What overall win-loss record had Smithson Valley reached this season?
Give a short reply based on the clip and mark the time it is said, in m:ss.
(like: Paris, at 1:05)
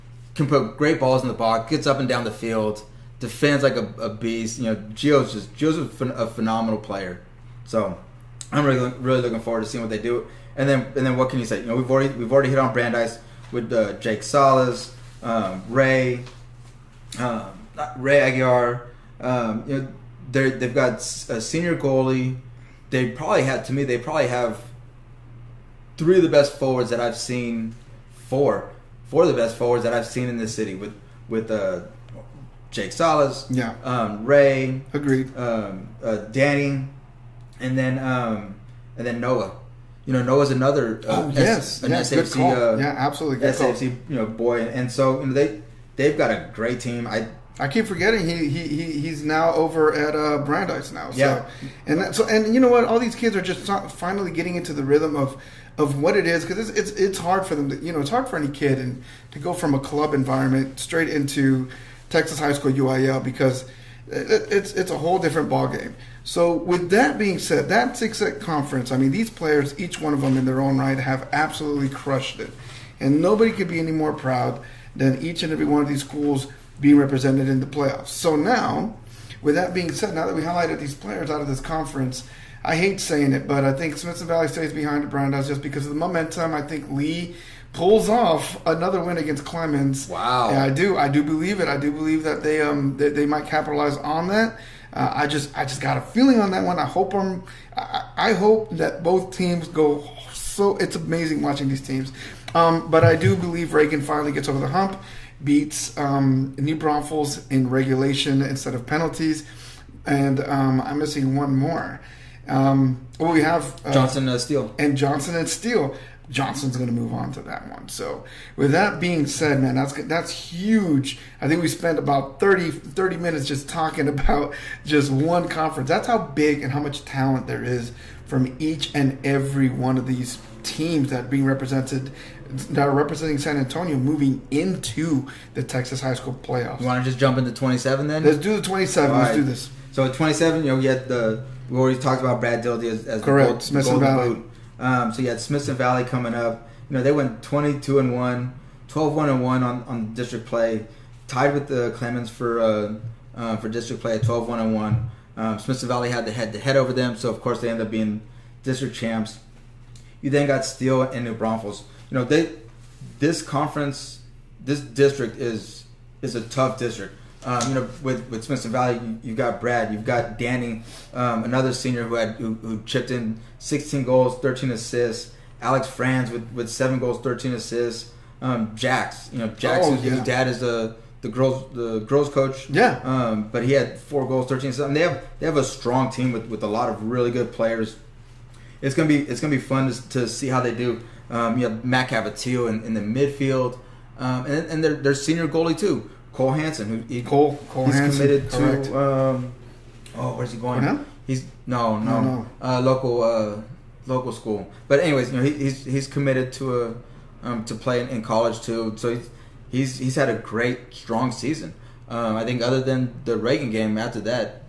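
22 and 1, at 2:27.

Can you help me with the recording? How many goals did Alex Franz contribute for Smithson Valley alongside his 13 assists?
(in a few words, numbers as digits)
7.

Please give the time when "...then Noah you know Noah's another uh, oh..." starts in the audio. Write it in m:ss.
0:39.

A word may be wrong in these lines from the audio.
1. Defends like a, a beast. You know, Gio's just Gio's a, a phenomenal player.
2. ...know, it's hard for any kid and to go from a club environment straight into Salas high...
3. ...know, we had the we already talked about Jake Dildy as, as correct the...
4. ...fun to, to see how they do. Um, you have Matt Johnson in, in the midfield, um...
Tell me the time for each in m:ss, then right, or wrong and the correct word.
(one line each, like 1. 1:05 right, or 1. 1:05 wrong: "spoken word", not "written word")
1. 0:03 right
2. 0:57 wrong: "Texas", not "Salas"
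3. 2:20 wrong: "Brad", not "Jake"
4. 3:09 wrong: "Cavatillo", not "Johnson".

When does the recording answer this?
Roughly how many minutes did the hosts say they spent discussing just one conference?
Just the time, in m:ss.
2:02.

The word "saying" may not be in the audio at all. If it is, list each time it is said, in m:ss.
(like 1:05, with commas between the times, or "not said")
1:22.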